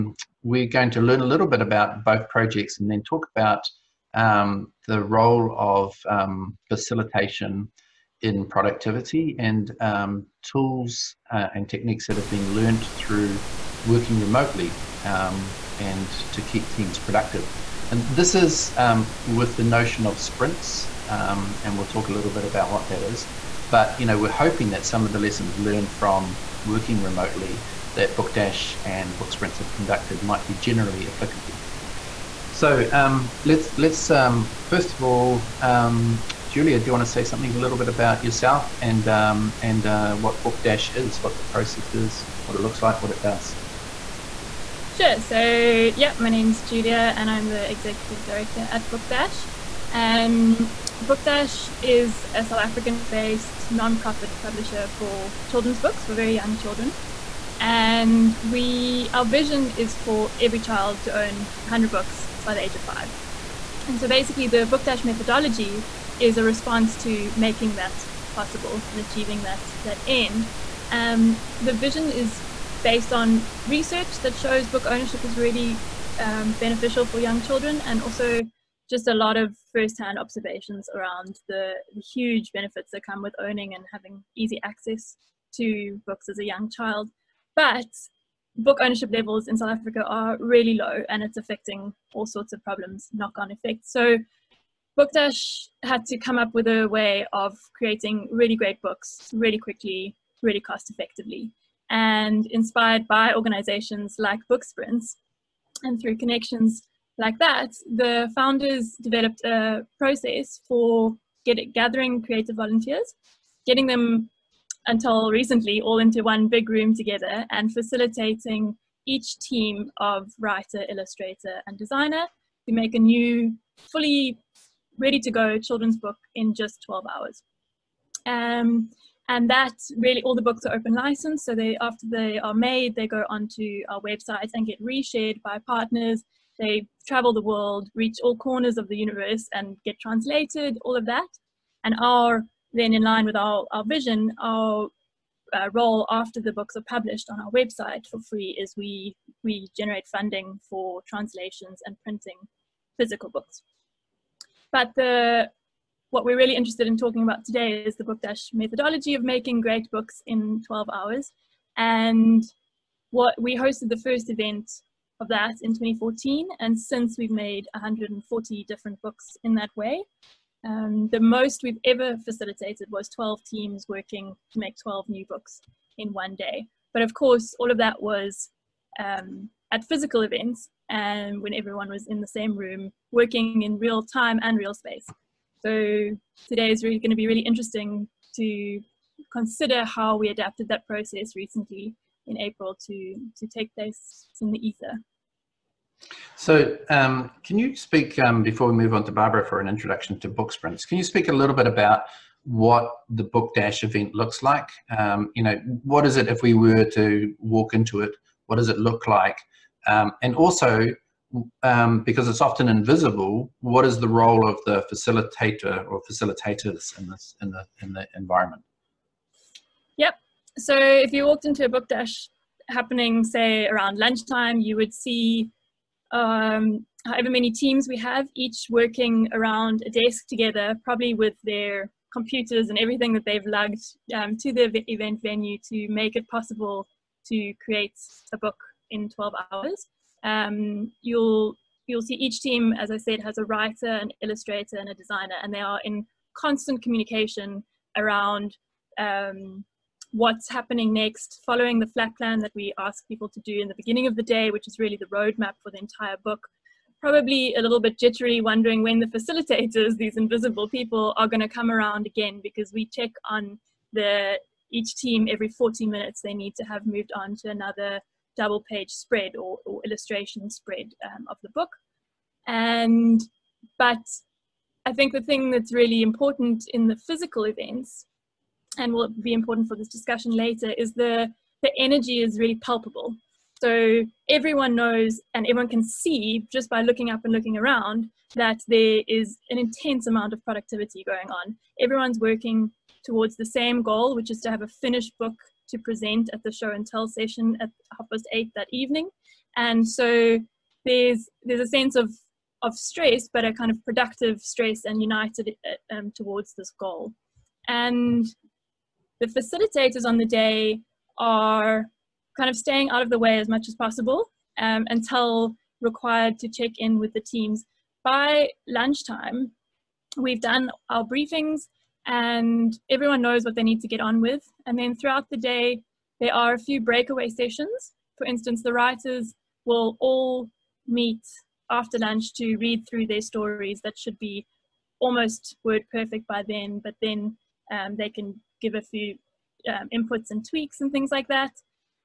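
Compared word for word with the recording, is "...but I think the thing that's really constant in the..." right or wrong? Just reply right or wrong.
wrong.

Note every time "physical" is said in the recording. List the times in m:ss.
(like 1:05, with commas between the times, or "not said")
2:32, 2:59, 4:36.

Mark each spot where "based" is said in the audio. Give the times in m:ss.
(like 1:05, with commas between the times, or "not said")
0:52, 1:12.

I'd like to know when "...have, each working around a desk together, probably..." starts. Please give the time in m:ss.
3:47.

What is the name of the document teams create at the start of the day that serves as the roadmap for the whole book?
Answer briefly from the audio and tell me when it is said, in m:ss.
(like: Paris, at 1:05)
flat plan, at 4:11.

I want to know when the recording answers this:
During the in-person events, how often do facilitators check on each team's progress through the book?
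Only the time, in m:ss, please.
4:25.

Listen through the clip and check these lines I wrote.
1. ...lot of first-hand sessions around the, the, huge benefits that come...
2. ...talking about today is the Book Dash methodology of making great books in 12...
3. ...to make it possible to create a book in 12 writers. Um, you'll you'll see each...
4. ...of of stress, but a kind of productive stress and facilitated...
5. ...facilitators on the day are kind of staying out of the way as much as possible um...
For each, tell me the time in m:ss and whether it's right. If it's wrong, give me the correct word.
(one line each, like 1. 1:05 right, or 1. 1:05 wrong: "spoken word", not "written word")
1. 1:19 wrong: "observations", not "sessions"
2. 2:36 right
3. 3:55 wrong: "hours", not "writers"
4. 5:01 wrong: "united", not "facilitated"
5. 5:09 right.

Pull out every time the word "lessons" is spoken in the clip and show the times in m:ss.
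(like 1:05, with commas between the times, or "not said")
0:25.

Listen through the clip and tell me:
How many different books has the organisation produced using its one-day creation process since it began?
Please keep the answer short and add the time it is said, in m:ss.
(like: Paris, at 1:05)
140, at 2:47.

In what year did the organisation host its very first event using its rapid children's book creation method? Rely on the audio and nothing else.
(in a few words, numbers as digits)
2014.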